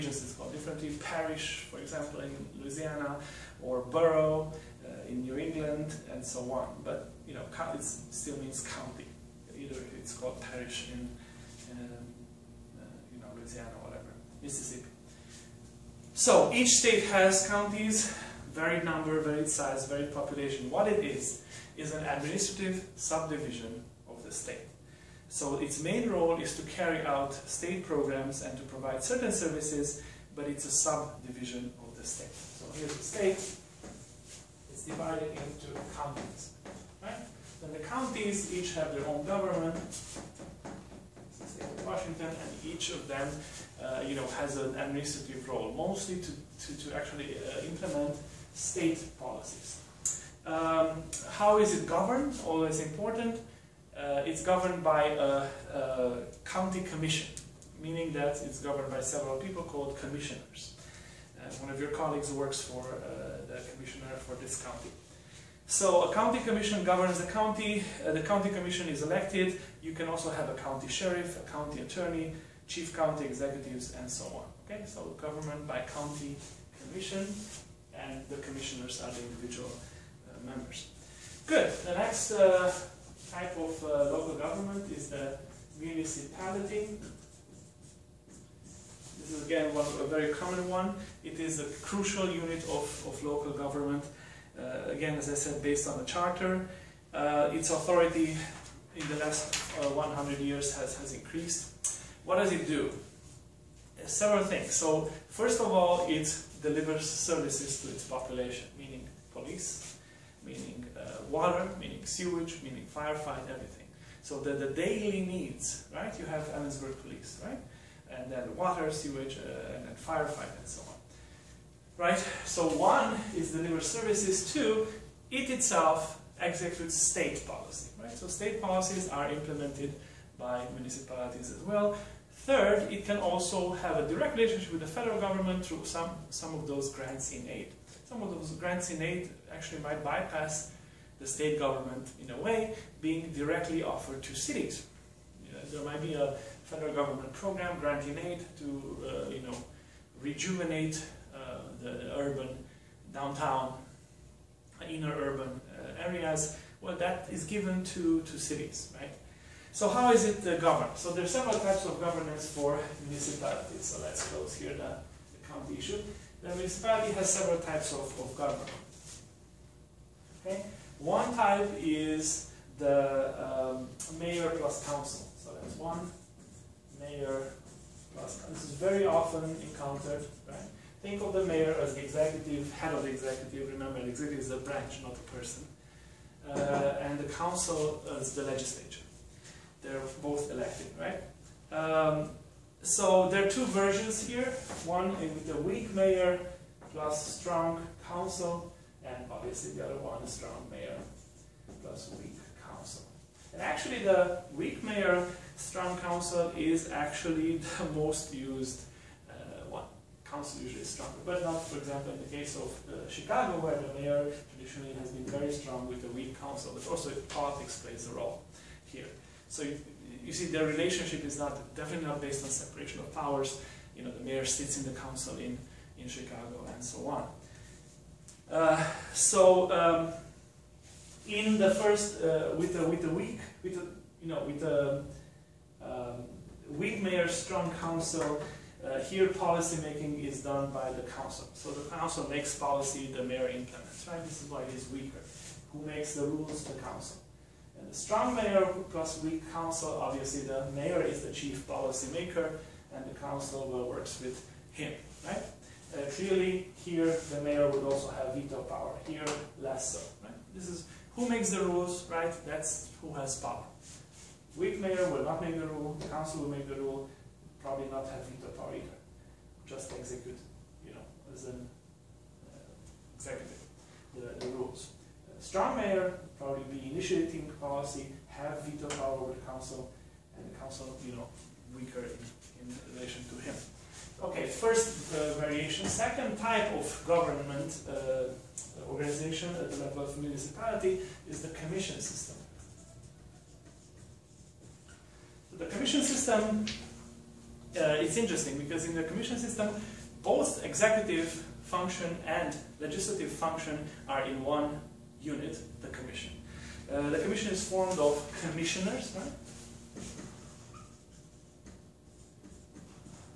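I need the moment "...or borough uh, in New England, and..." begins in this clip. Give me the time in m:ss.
0:03.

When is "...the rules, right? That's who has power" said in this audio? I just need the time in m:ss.
4:21.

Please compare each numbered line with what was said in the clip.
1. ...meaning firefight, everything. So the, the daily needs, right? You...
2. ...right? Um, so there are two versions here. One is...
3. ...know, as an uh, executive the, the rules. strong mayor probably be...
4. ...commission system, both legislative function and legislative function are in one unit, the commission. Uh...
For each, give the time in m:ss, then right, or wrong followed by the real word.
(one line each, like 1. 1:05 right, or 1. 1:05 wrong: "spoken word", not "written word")
1. 1:52 right
2. 3:10 right
3. 4:30 right
4. 4:59 wrong: "executive", not "legislative".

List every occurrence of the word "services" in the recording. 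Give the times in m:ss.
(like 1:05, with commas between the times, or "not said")
0:29, 1:47, 2:03.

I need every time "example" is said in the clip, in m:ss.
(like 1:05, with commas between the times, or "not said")
0:01, 3:31.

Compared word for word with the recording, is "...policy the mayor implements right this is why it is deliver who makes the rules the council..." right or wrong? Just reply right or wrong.
wrong.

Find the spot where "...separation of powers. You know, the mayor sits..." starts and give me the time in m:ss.
3:42.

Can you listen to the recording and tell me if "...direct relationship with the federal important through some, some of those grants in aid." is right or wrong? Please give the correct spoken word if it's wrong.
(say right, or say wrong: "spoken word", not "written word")
wrong: "government", not "important".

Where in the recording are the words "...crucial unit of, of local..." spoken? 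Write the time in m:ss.
1:31.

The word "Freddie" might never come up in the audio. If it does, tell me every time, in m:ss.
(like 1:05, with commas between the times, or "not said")
not said.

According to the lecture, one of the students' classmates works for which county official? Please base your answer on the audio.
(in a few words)
the commissioner.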